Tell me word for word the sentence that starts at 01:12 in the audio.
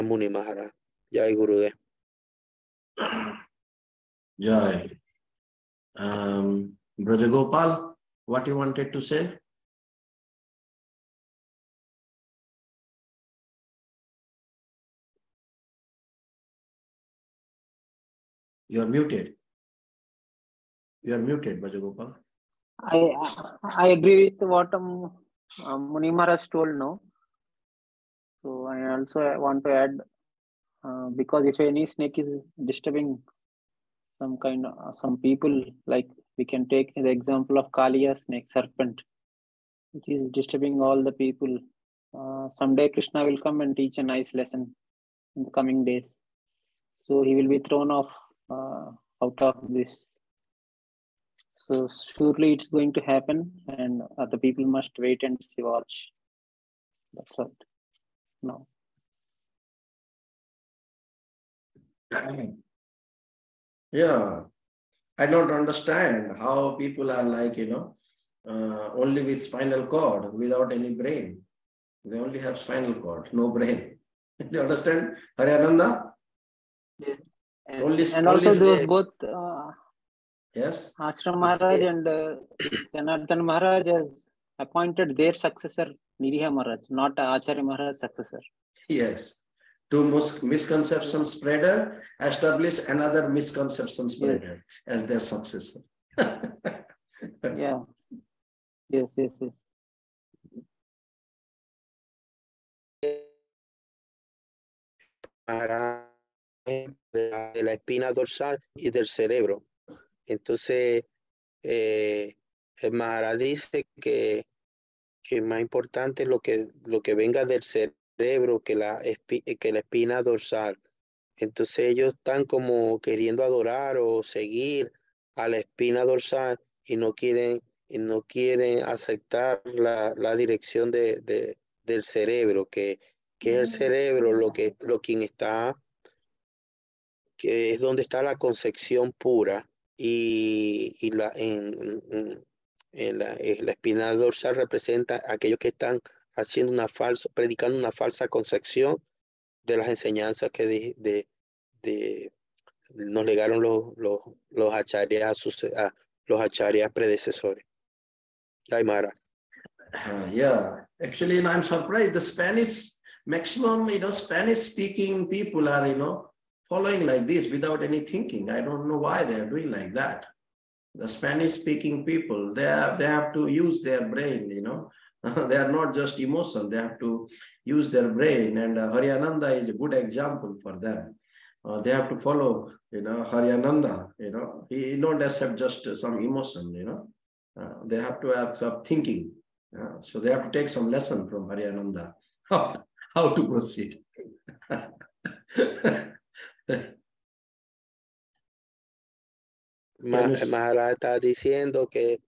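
They only have spinal cord, no brain.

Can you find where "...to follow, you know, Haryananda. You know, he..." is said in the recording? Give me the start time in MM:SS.
03:02.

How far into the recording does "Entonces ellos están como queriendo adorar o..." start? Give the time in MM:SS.
02:01.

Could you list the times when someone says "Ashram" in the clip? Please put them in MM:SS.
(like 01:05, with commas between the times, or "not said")
01:20.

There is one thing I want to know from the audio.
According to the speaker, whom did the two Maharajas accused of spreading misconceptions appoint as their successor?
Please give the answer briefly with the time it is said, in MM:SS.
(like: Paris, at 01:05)
Niriha Maharaj, at 01:26.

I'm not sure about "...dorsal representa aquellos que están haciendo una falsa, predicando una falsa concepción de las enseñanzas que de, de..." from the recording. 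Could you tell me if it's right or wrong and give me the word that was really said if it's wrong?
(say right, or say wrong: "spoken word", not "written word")
right.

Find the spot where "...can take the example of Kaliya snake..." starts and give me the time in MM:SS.
00:36.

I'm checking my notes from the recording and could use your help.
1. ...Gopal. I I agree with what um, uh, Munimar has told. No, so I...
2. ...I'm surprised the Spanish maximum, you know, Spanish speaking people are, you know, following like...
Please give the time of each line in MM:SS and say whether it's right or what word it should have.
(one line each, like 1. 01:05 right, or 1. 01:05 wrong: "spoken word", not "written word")
1. 00:21 right
2. 02:41 right.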